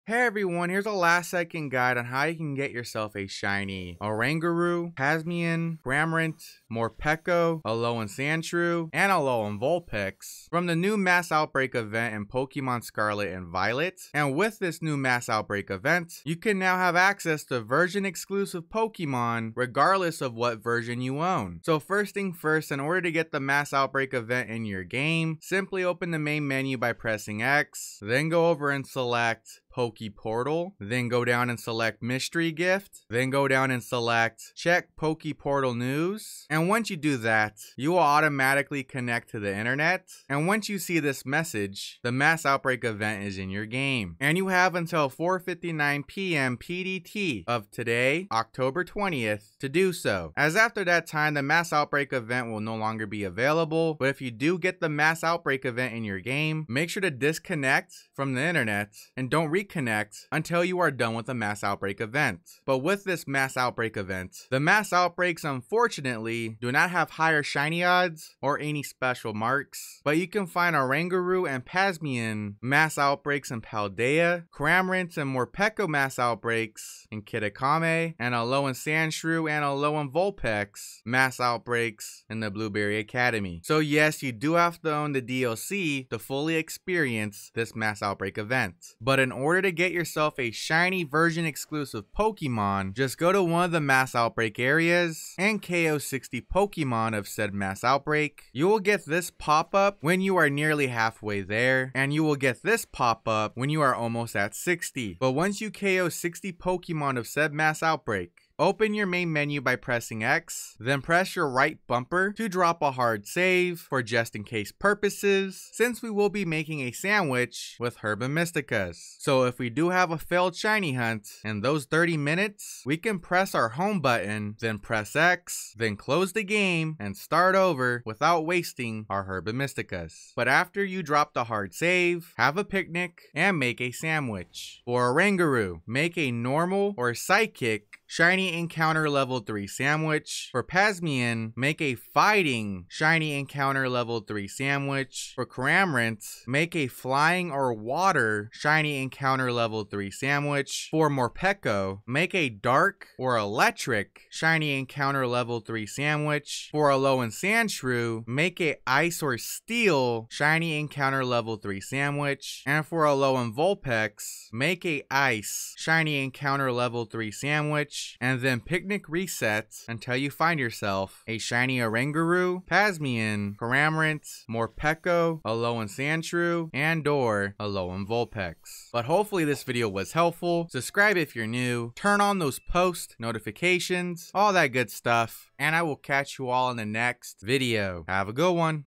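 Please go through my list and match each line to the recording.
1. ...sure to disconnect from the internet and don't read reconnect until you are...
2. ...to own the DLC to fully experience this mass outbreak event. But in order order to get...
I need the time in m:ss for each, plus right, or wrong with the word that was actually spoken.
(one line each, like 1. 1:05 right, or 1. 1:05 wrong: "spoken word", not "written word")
1. 0:56 right
2. 1:24 right.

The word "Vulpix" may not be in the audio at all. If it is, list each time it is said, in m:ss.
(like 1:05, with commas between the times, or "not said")
0:09, 1:20, 2:43, 2:58.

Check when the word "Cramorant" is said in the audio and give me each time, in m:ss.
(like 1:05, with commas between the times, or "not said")
0:05, 1:14, 2:25, 2:53.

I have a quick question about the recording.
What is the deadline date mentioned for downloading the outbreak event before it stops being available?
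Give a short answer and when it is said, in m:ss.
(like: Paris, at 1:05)
October 20th, at 0:48.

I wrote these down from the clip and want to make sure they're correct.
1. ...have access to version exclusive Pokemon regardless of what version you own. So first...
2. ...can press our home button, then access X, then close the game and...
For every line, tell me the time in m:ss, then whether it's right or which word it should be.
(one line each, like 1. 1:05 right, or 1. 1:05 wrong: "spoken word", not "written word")
1. 0:16 right
2. 2:02 wrong: "press", not "access".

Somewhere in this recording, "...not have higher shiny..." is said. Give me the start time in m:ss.
1:06.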